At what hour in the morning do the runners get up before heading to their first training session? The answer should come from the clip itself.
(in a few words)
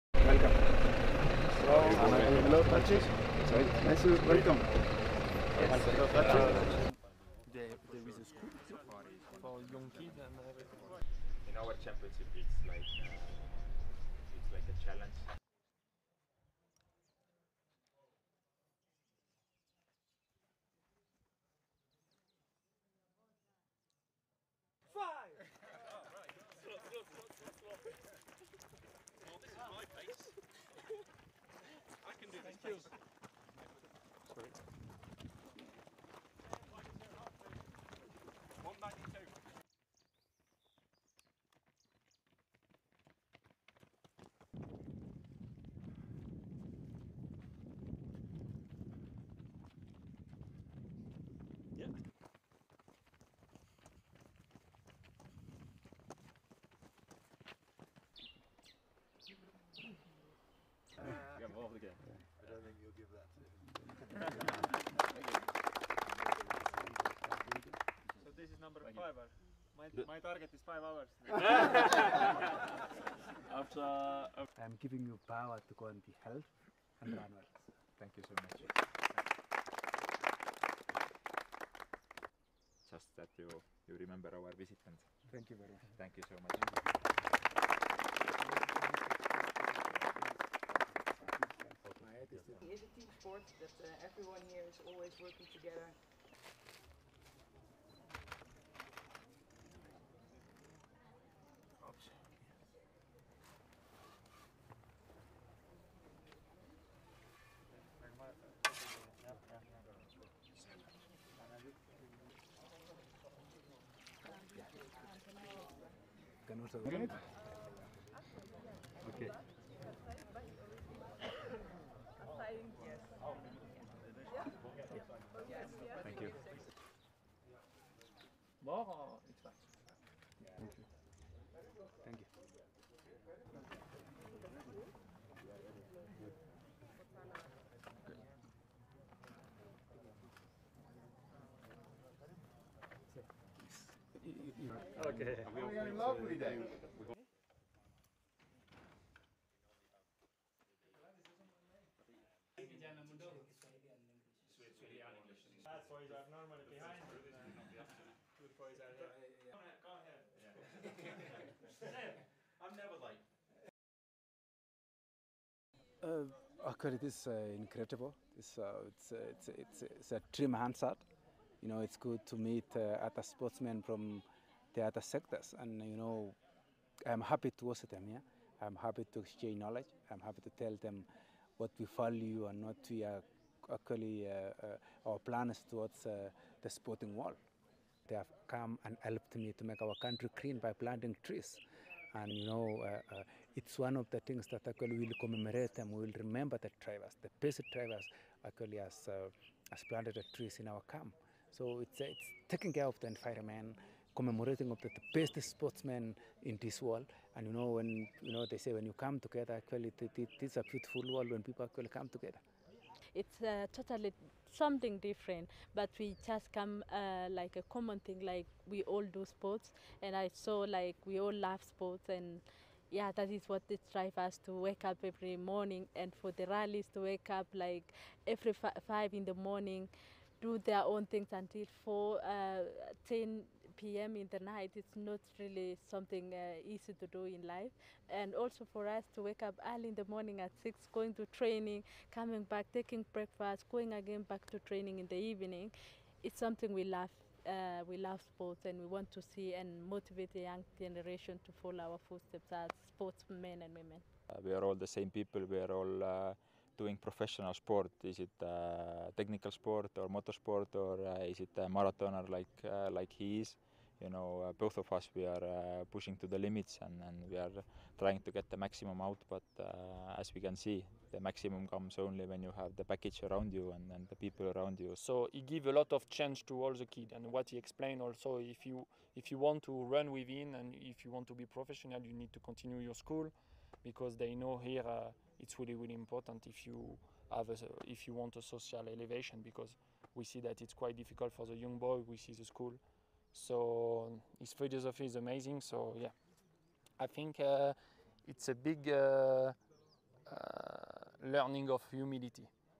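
6.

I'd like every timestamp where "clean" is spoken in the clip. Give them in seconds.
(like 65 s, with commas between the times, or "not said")
190 s.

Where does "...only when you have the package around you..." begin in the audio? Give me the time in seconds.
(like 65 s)
271 s.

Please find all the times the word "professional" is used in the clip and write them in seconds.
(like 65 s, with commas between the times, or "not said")
257 s, 281 s.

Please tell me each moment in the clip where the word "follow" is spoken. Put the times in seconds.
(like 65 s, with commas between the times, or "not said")
251 s.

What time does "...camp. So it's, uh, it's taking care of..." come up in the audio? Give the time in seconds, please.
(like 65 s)
200 s.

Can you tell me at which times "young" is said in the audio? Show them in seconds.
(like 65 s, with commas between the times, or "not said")
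9 s, 250 s, 291 s.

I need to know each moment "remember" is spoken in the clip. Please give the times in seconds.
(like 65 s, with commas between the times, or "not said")
83 s, 196 s.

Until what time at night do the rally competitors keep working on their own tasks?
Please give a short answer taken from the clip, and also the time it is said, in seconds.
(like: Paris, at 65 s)
10 p.m., at 233 s.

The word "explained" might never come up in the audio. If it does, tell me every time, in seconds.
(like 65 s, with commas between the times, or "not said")
277 s.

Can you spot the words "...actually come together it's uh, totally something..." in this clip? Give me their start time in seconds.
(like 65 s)
211 s.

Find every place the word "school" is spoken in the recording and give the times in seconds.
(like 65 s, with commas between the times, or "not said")
8 s, 282 s, 292 s.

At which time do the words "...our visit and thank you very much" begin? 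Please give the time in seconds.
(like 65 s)
84 s.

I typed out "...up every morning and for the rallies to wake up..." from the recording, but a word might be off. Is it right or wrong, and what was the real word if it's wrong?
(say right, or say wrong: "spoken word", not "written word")
right.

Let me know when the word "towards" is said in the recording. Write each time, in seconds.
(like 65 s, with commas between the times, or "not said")
185 s.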